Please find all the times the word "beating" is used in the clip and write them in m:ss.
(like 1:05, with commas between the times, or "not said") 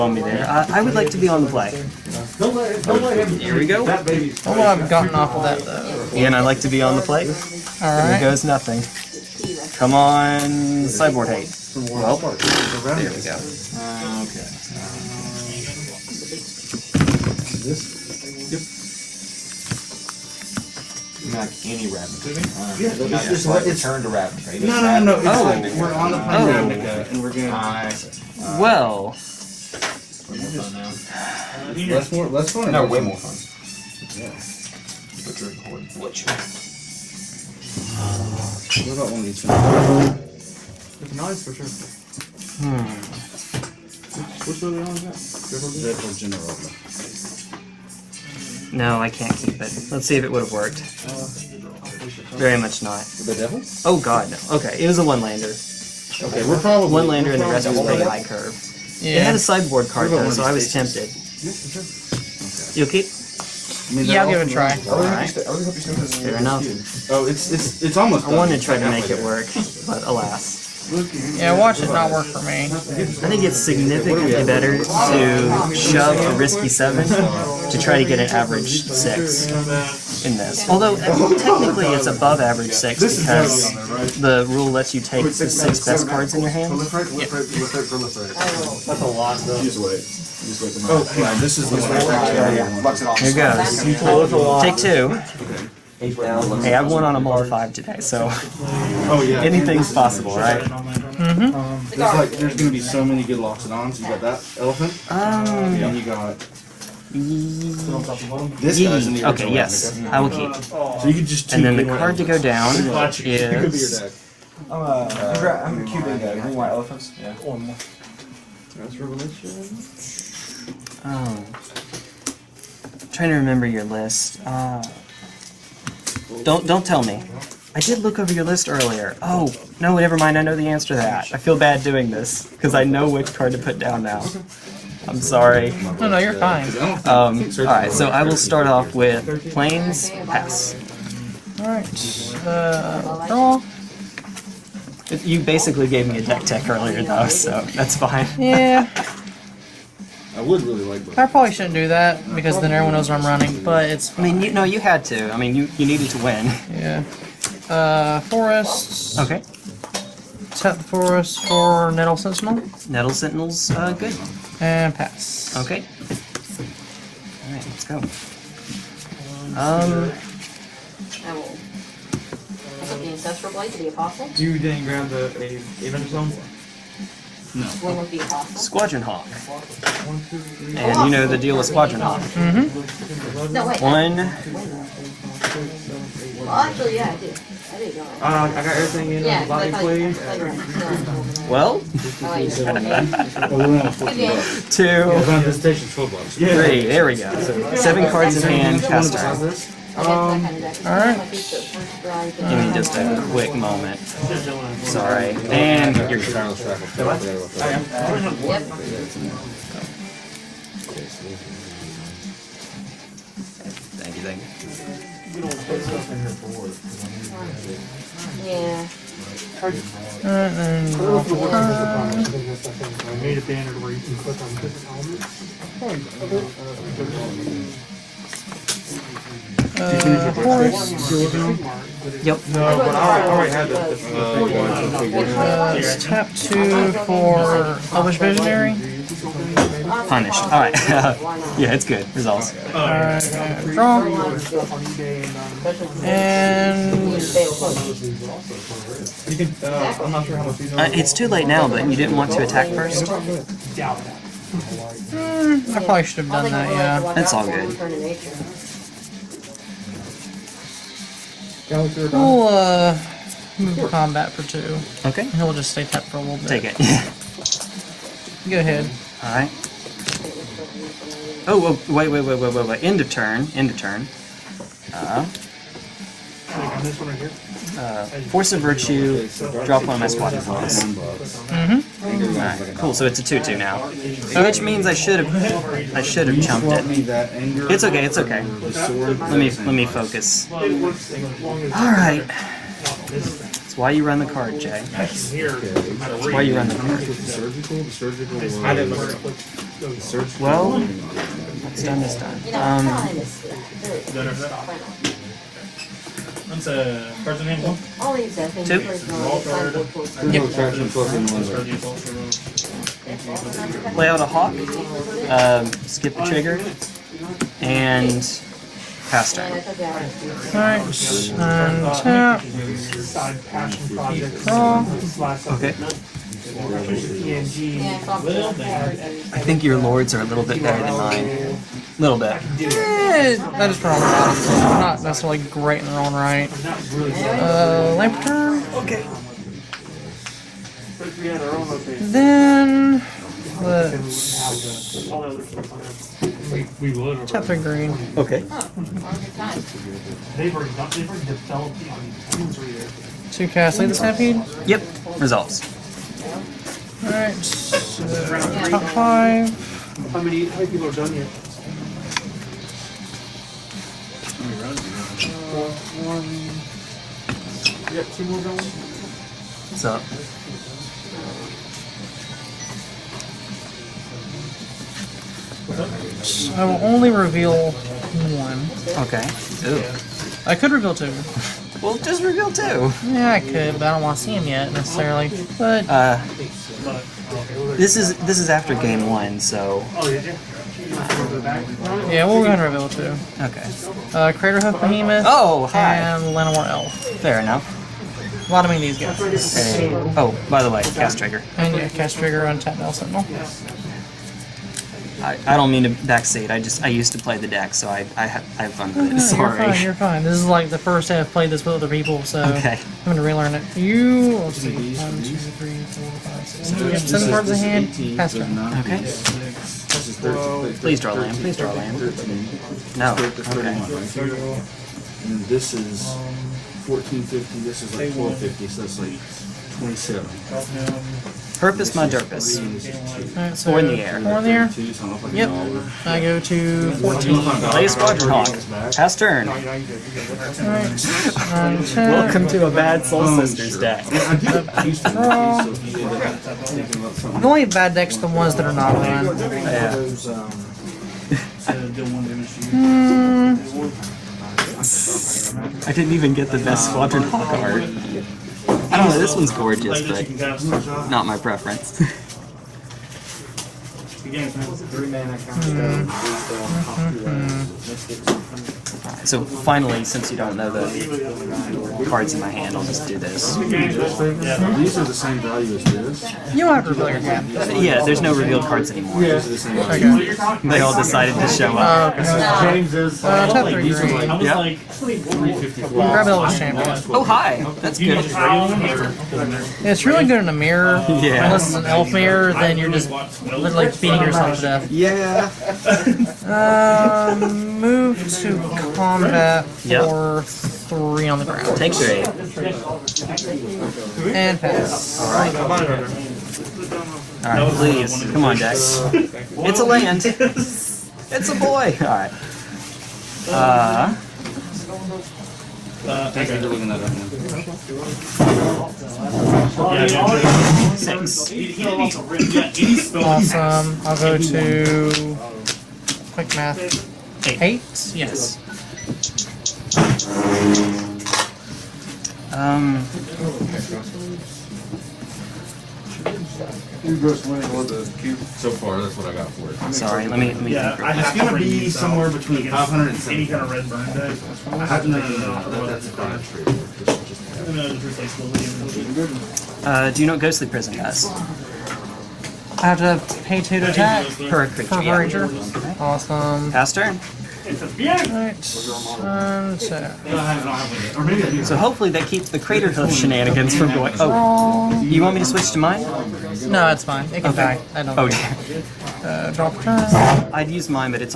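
8:13.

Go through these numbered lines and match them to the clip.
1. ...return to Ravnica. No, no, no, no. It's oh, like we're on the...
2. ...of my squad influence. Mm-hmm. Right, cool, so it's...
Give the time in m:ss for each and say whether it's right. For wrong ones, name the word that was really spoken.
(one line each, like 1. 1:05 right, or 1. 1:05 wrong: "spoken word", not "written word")
1. 0:23 right
2. 4:39 right.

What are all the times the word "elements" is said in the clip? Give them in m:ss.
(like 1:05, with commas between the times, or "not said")
3:44.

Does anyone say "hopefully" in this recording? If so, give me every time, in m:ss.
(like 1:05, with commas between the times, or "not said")
9:21.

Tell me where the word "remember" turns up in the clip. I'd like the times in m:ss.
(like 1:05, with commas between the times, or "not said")
2:03.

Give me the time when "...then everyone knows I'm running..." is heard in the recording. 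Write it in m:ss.
2:32.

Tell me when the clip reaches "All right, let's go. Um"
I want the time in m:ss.
2:47.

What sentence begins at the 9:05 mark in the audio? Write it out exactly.
That's a Uh, do you know Ghostly Prison does?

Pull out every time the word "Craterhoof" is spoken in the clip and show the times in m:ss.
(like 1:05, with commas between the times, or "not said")
6:34, 9:22.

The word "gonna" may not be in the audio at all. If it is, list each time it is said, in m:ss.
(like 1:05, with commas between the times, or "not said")
1:42, 6:53, 9:01.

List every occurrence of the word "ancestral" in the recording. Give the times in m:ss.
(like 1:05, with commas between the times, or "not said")
2:53.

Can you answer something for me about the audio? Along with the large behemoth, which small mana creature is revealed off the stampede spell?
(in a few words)
Llanowar Elf.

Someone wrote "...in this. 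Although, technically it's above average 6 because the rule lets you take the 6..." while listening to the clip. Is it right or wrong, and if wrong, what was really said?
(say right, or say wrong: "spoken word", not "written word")
right.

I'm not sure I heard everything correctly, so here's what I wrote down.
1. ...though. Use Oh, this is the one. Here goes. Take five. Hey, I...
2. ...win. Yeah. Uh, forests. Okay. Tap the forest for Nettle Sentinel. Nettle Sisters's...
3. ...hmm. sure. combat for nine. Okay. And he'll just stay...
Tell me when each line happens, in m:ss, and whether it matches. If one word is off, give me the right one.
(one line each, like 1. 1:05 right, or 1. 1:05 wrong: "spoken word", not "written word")
1. 1:29 wrong: "two", not "five"
2. 2:36 wrong: "Sentinel", not "Sisters"
3. 4:23 wrong: "two", not "nine".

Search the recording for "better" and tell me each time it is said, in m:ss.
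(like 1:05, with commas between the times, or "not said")
1:14, 5:30.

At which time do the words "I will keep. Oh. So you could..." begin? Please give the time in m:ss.
1:50.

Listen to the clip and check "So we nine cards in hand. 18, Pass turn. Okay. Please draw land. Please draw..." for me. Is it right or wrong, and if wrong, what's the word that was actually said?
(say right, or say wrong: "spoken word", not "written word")
wrong: "seven", not "nine".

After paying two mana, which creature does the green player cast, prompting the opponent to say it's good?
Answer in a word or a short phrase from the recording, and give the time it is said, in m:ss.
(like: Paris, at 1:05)
Elvish Visionary, at 3:57.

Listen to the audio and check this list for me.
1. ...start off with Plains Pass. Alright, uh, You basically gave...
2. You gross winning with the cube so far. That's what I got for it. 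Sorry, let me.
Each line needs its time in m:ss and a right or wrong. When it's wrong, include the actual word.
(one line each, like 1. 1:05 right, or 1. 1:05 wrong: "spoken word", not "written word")
1. 2:18 right
2. 8:57 right.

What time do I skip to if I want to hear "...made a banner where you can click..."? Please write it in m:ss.
3:43.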